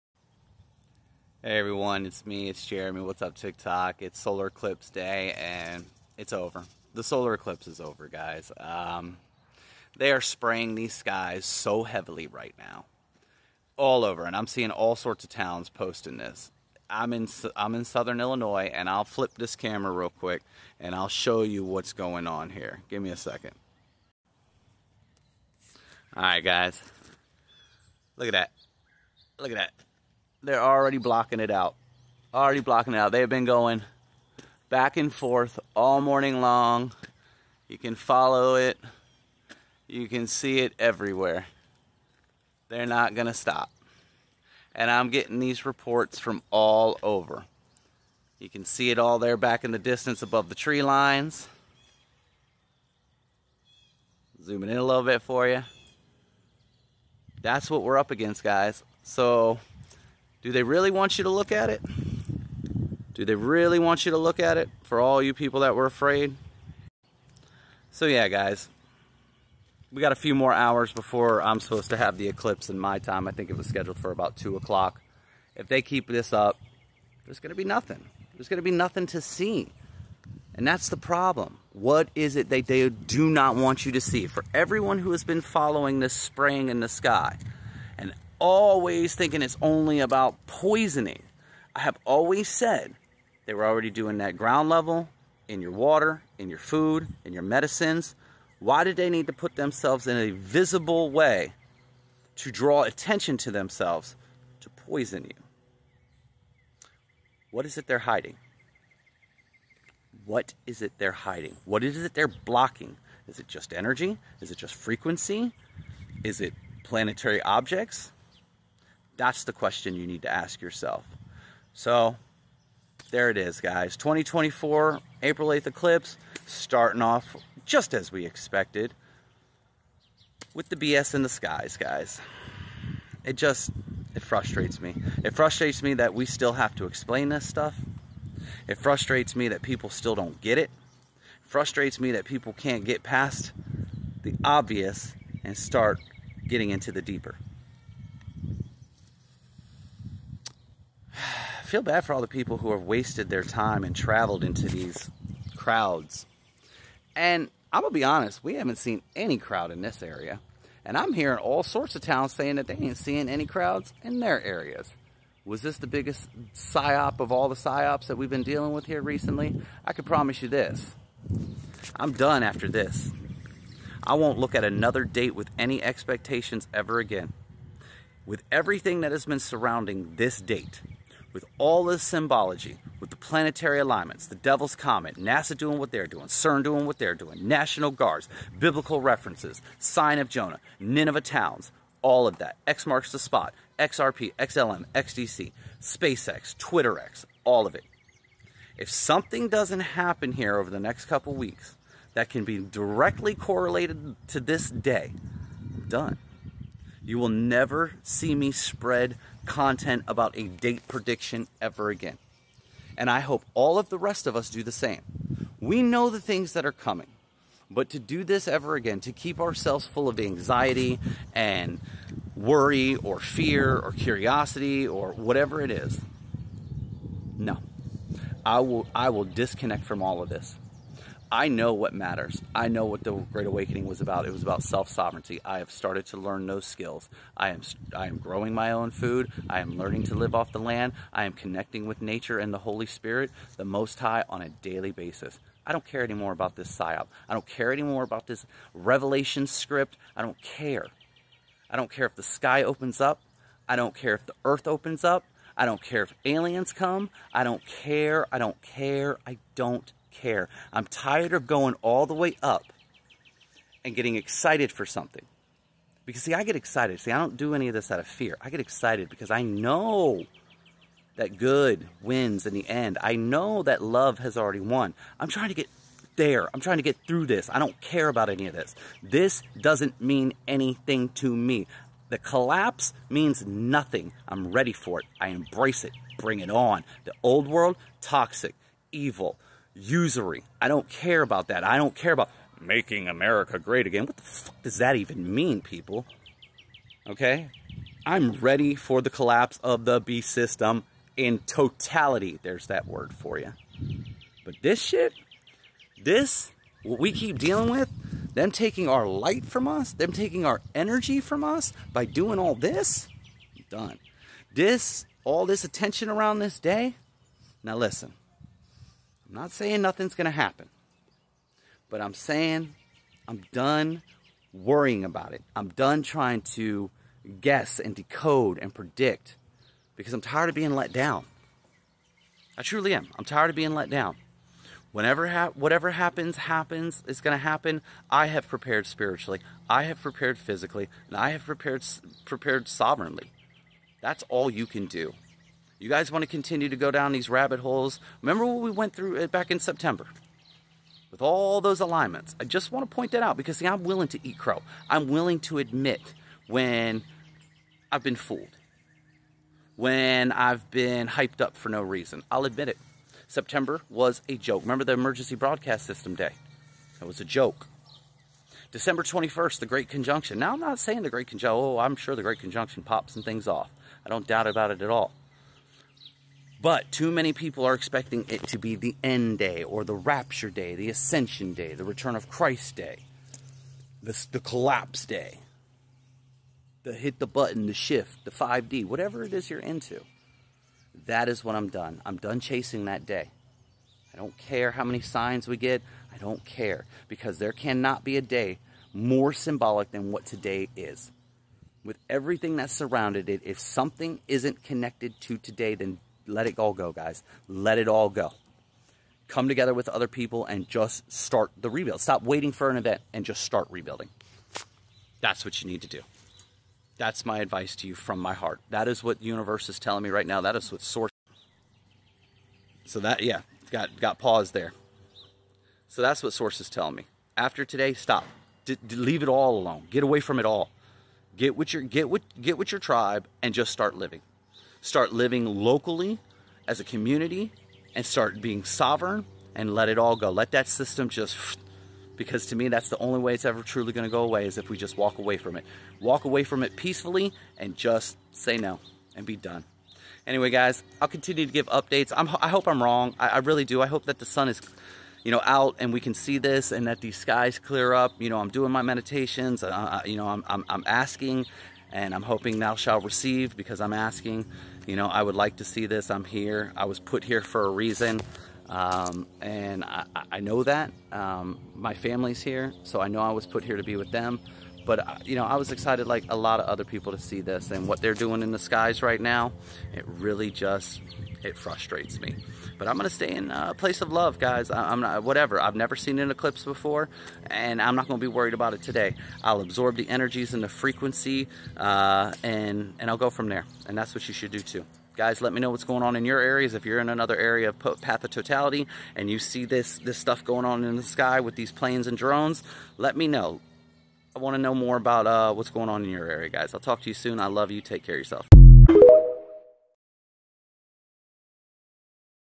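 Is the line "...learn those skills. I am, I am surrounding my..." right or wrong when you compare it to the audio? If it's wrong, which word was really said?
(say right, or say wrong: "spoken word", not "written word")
wrong: "growing", not "surrounding".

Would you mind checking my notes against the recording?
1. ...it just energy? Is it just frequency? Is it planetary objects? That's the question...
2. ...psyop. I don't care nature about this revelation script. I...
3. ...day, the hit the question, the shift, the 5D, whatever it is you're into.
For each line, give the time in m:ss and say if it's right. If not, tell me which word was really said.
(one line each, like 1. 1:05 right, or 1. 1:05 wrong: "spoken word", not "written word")
1. 1:53 right
2. 4:06 wrong: "anymore", not "nature"
3. 6:25 wrong: "button", not "question".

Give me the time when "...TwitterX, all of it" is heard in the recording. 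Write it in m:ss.
3:16.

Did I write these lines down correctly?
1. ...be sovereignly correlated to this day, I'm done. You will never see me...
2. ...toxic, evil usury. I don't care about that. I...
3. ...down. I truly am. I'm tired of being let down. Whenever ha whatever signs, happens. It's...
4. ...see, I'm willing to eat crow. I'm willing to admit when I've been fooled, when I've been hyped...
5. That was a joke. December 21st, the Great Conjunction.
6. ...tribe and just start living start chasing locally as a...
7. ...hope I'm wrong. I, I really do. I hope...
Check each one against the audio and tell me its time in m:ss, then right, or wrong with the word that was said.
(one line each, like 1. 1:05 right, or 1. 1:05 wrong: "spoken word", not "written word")
1. 3:22 wrong: "directly", not "sovereignly"
2. 4:48 right
3. 5:30 wrong: "happens", not "signs"
4. 5:53 right
5. 6:06 right
6. 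7:12 wrong: "living", not "chasing"
7. 7:32 right.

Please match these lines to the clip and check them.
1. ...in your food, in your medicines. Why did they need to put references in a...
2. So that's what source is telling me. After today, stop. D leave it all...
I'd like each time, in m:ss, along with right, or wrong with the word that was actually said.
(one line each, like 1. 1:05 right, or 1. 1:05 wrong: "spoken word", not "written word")
1. 1:36 wrong: "themselves", not "references"
2. 7:05 right.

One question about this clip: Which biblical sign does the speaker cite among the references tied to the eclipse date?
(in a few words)
Sign of Jonah.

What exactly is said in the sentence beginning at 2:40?
And I'm hearing all sorts of towns saying that they ain't seeing any crowds in their areas.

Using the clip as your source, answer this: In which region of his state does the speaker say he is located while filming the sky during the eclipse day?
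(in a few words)
Southern Illinois.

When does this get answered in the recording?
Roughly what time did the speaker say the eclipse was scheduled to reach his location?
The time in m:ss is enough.
1:14.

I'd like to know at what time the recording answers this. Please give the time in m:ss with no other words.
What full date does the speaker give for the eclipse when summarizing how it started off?
2:03.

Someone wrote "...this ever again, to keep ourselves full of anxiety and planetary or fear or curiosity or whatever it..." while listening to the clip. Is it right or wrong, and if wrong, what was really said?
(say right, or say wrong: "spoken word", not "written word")
wrong: "worry", not "planetary".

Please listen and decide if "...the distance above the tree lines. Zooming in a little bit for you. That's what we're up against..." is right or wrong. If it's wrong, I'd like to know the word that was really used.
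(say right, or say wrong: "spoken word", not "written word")
right.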